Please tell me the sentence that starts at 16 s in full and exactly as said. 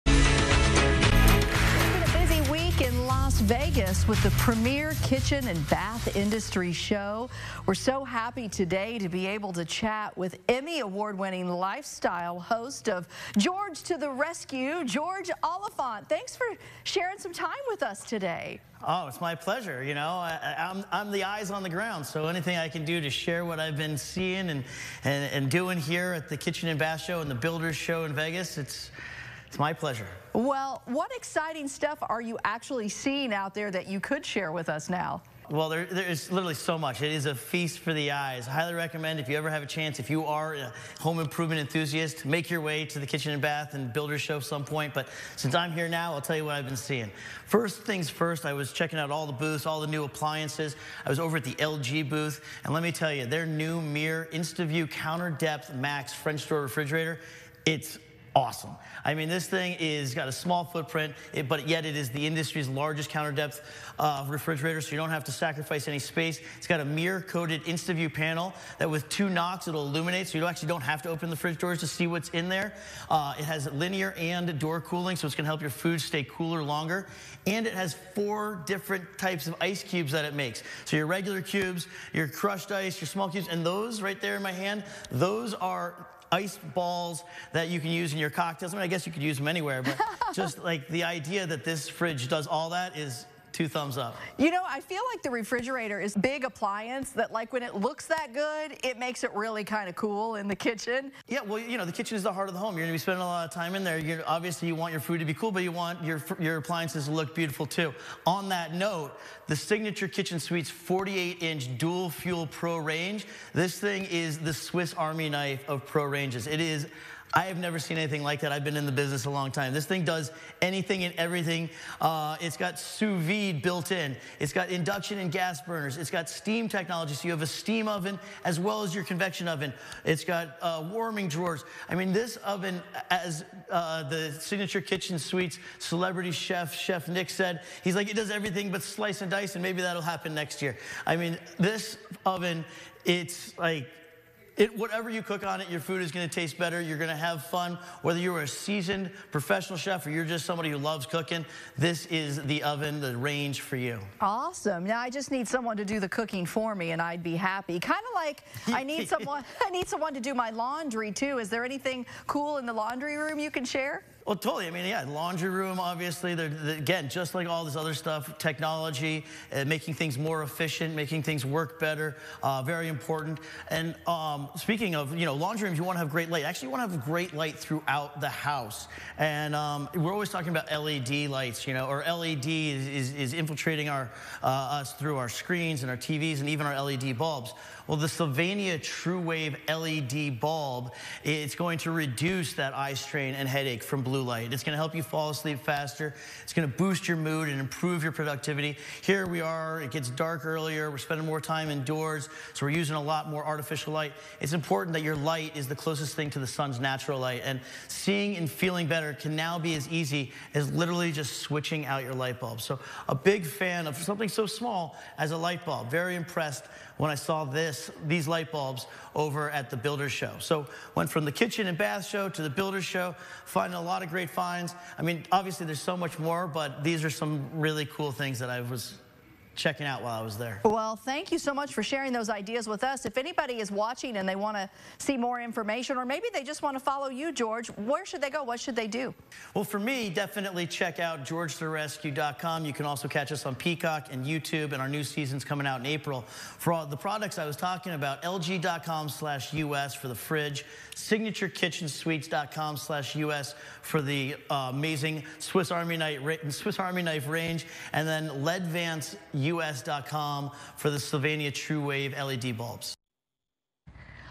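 Thanks for sharing some time with us today.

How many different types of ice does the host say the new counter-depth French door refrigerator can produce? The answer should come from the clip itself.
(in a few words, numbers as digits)
4.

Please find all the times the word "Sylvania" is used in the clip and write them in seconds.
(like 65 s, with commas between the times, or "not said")
188 s, 260 s.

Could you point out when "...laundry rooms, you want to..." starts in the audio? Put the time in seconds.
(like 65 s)
175 s.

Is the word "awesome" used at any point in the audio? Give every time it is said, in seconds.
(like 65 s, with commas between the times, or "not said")
58 s, 154 s.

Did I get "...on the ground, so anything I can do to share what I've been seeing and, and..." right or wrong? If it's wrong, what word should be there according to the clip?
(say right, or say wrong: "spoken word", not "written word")
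right.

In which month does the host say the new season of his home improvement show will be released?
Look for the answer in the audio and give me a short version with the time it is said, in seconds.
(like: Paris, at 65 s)
April, at 245 s.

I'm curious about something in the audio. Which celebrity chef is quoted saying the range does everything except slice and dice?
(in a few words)
Chef Nick.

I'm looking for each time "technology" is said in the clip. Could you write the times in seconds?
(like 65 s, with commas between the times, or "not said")
126 s, 168 s.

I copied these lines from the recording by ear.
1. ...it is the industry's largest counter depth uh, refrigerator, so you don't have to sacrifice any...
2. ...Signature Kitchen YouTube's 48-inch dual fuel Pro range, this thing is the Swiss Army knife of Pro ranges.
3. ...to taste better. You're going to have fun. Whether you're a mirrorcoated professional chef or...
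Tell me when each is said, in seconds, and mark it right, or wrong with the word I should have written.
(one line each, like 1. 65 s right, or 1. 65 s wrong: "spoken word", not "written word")
1. 61 s right
2. 109 s wrong: "Suite", not "YouTube"
3. 146 s wrong: "seasoned", not "mirrorcoated".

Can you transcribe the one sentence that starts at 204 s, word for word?
It's important that your light is the closest thing to the sun's natural light.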